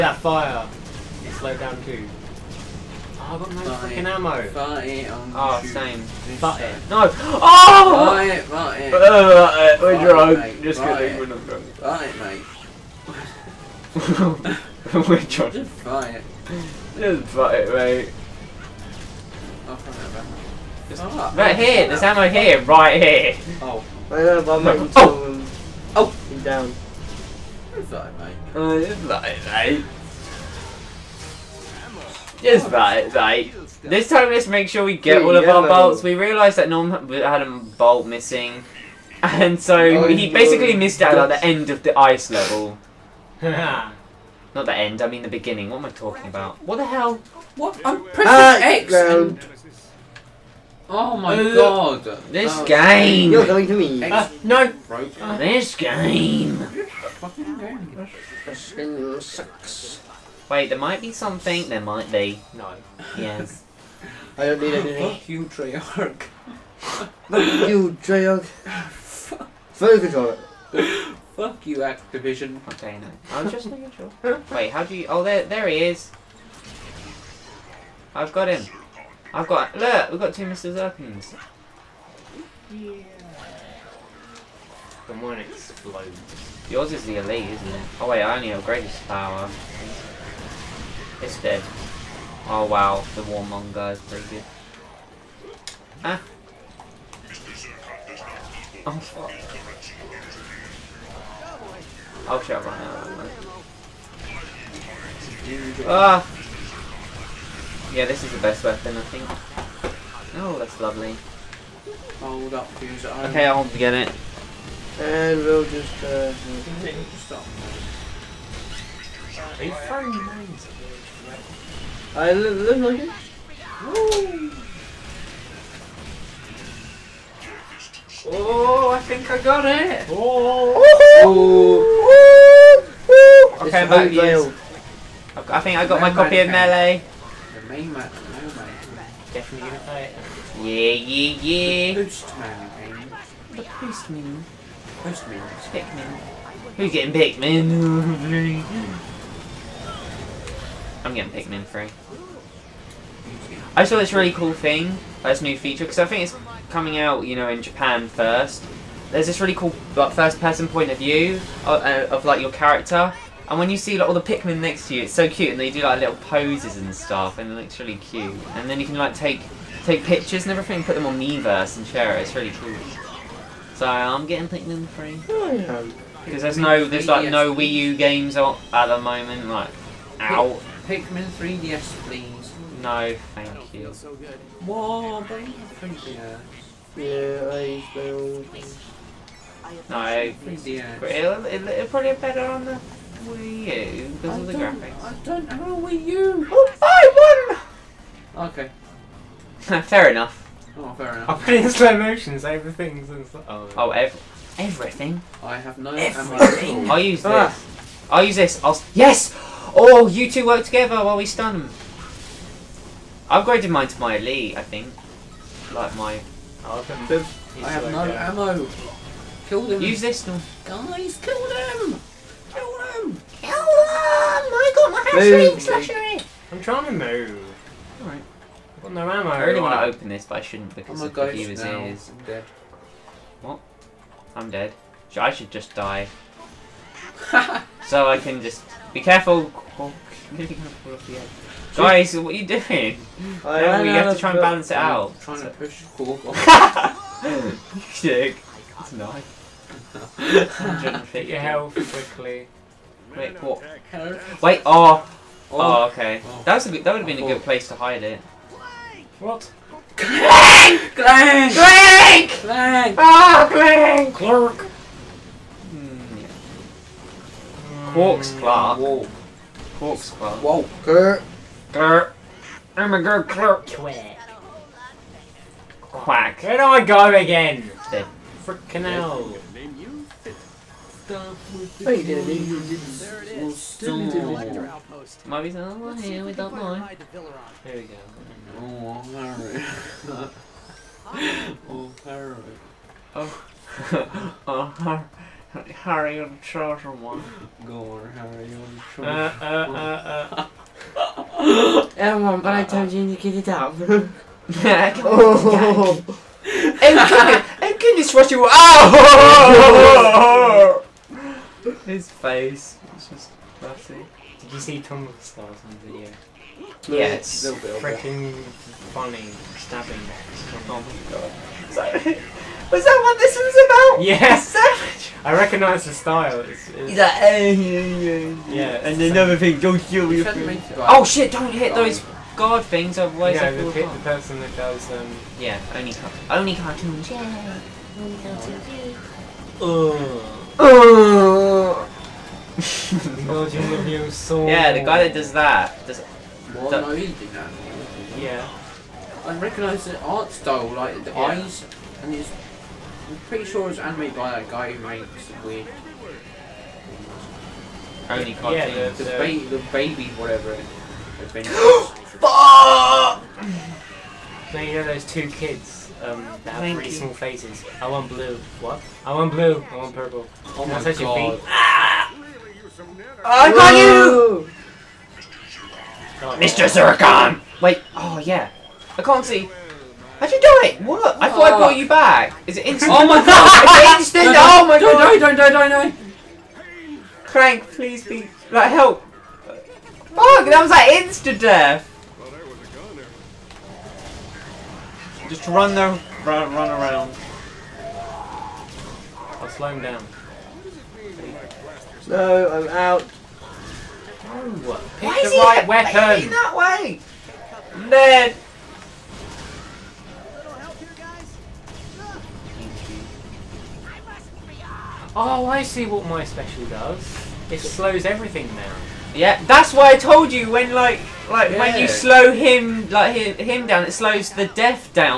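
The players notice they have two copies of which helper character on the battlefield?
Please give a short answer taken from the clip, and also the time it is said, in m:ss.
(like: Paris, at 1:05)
Mr. Zurkon, at 1:20.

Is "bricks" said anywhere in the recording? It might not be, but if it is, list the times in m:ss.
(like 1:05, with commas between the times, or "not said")
not said.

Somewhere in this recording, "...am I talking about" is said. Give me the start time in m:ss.
0:45.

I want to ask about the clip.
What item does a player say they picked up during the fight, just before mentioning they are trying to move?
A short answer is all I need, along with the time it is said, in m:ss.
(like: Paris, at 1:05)
hamstring slasher, at 3:45.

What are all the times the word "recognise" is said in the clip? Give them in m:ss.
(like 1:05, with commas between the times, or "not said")
5:25, 5:49.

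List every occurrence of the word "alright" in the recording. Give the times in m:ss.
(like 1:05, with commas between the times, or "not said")
3:48, 4:50.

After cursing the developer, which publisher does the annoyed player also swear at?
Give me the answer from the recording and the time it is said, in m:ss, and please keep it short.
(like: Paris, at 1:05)
Activision, at 1:11.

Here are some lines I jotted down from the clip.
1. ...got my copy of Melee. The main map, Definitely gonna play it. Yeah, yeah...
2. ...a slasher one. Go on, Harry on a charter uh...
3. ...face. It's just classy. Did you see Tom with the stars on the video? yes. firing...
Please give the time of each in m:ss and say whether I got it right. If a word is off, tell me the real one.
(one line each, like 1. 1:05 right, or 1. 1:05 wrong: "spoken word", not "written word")
1. 2:15 right
2. 4:56 wrong: "charter", not "slasher"
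3. 5:12 wrong: "freaking", not "firing".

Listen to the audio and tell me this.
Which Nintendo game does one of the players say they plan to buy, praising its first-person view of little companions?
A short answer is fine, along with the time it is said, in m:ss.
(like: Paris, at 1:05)
Pikmin 3, at 2:31.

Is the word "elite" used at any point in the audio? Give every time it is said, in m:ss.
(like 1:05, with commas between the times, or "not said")
1:27, 3:34.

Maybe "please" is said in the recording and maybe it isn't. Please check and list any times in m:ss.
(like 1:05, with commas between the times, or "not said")
3:02, 6:27.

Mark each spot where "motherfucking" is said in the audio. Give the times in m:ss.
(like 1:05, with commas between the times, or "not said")
not said.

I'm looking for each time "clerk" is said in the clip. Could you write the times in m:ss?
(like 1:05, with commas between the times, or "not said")
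4:24, 4:33.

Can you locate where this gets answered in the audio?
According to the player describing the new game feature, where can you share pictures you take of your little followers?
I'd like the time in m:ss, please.
2:51.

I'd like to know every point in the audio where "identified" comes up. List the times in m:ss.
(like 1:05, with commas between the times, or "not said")
not said.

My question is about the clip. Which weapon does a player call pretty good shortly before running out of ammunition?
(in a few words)
Warmonger.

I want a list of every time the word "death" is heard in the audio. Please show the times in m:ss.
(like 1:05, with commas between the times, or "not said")
6:31, 7:04.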